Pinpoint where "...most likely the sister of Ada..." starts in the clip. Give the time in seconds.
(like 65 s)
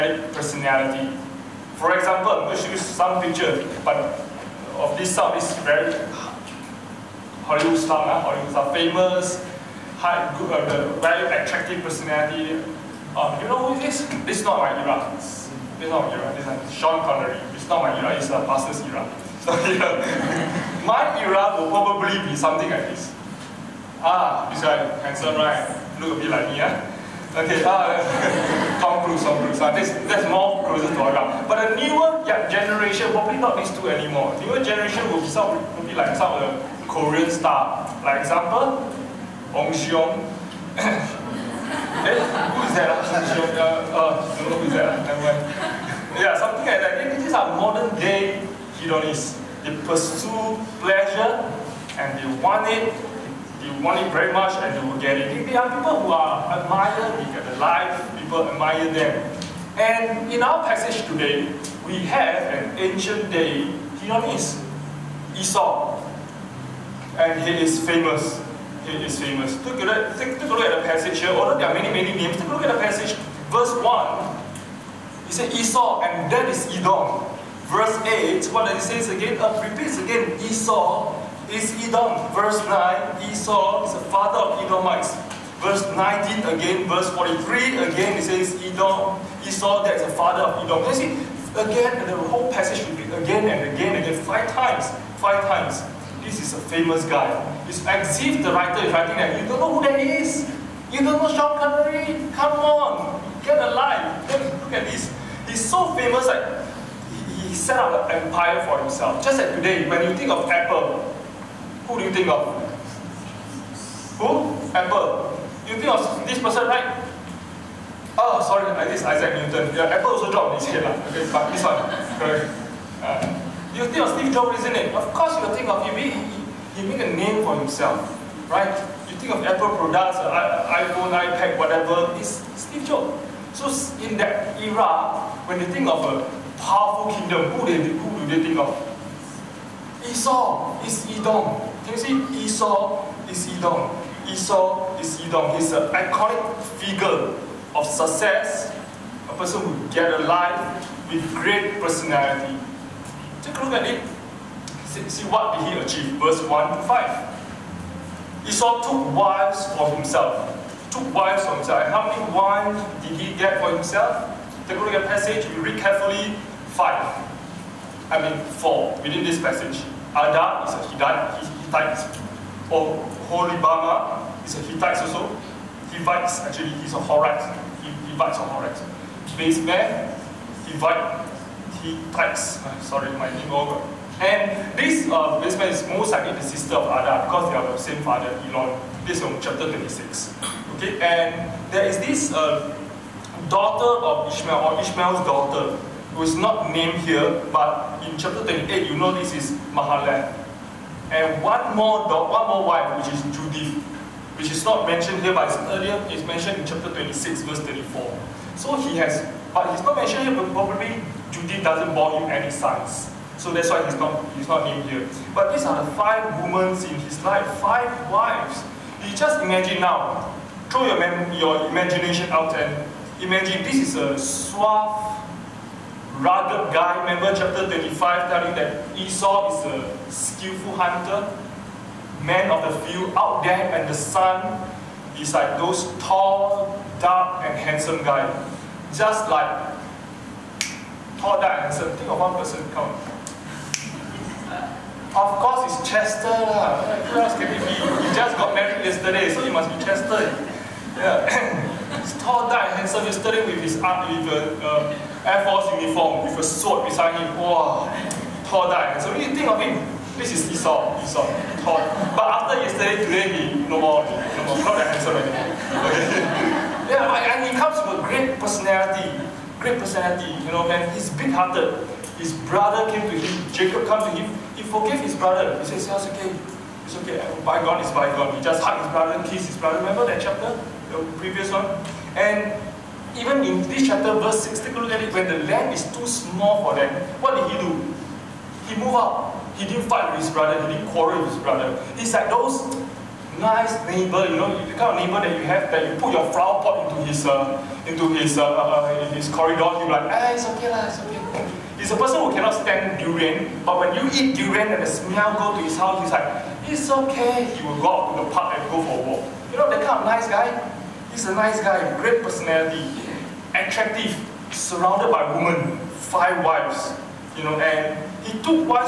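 185 s.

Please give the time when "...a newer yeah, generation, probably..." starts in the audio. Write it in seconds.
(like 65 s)
31 s.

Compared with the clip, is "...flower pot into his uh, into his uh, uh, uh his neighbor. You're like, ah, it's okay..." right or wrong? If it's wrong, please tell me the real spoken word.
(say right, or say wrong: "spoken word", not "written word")
wrong: "corridor", not "neighbor".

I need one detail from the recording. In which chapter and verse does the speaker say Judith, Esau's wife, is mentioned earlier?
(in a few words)
Chapter 26, verse 34.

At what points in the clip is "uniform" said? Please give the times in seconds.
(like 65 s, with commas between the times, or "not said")
255 s.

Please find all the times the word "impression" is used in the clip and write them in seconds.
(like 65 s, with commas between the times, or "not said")
not said.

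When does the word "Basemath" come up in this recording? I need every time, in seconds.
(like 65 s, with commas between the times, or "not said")
179 s, 185 s.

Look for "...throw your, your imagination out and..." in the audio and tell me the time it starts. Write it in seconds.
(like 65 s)
220 s.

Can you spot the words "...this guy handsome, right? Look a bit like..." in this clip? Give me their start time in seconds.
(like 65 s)
24 s.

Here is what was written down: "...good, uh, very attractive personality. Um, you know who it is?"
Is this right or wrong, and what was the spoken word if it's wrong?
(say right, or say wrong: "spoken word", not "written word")
right.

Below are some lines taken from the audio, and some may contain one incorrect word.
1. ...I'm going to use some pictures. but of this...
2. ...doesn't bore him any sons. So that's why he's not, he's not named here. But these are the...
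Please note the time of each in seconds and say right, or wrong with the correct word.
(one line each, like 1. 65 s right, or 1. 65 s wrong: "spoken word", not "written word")
1. 2 s right
2. 211 s right.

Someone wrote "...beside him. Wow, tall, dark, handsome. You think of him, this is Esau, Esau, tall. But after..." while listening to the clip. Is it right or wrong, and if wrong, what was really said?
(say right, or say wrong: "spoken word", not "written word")
right.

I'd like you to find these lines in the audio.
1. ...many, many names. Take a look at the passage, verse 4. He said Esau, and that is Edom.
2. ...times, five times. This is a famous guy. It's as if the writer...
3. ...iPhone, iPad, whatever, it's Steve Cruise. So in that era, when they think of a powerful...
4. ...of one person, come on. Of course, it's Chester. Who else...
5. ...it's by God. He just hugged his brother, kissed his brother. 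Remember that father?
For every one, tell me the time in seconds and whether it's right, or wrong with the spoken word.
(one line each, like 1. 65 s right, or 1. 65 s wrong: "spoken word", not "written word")
1. 71 s wrong: "1", not "4"
2. 94 s right
3. 130 s wrong: "Jobs", not "Cruise"
4. 242 s right
5. 277 s wrong: "chapter", not "father".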